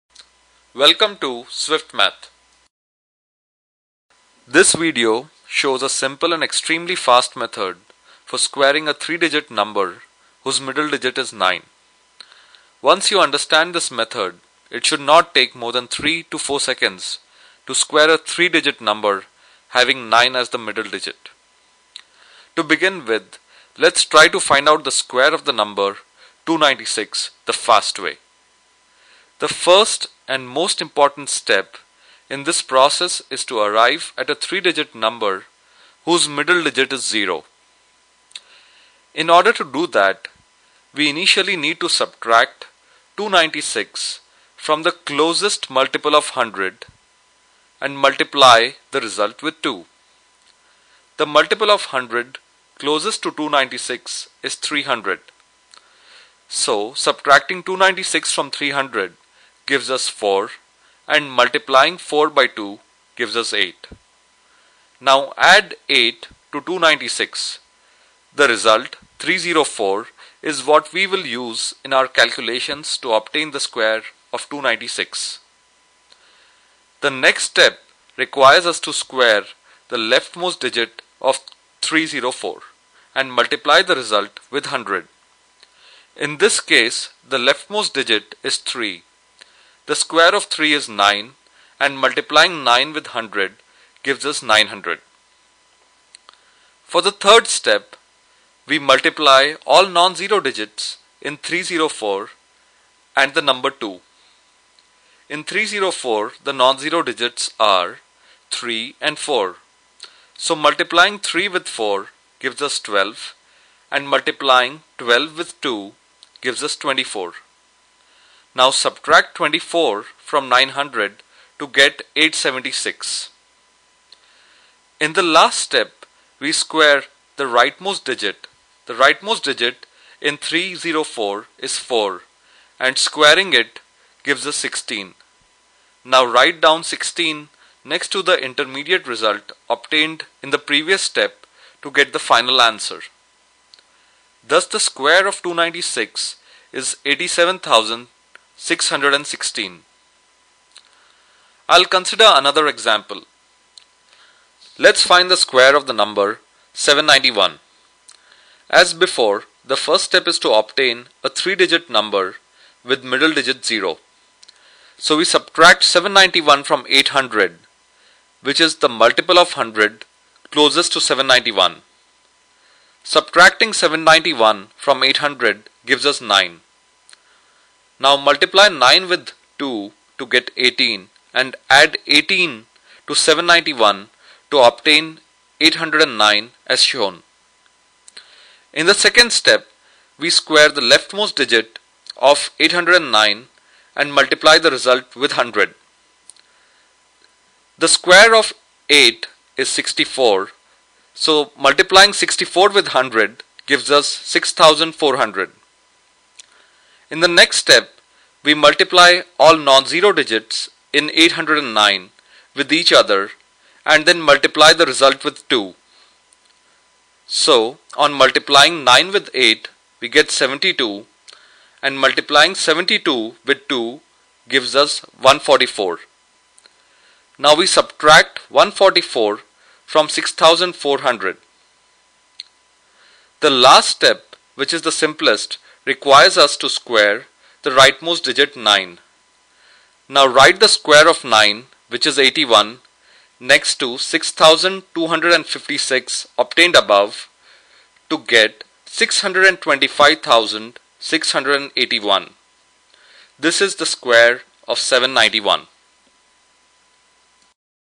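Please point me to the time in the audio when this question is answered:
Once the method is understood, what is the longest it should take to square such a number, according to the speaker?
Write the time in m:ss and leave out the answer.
0:15.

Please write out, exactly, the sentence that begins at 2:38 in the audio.
As before, the first step is to obtain a three-digit number with middle digit 0.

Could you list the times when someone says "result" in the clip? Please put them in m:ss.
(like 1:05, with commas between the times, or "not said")
0:49, 1:08, 1:23, 2:19, 3:14, 3:34.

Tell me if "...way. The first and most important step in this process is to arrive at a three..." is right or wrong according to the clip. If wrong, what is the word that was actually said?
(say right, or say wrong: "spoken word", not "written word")
right.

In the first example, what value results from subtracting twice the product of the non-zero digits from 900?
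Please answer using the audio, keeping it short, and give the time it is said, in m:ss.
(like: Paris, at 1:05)
876, at 2:02.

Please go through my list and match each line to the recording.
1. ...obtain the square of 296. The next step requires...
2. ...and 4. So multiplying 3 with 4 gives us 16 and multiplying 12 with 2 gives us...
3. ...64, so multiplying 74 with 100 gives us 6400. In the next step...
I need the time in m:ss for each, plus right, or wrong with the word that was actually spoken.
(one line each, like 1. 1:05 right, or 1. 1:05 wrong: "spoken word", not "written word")
1. 1:13 right
2. 1:49 wrong: "12", not "16"
3. 3:19 wrong: "64", not "74".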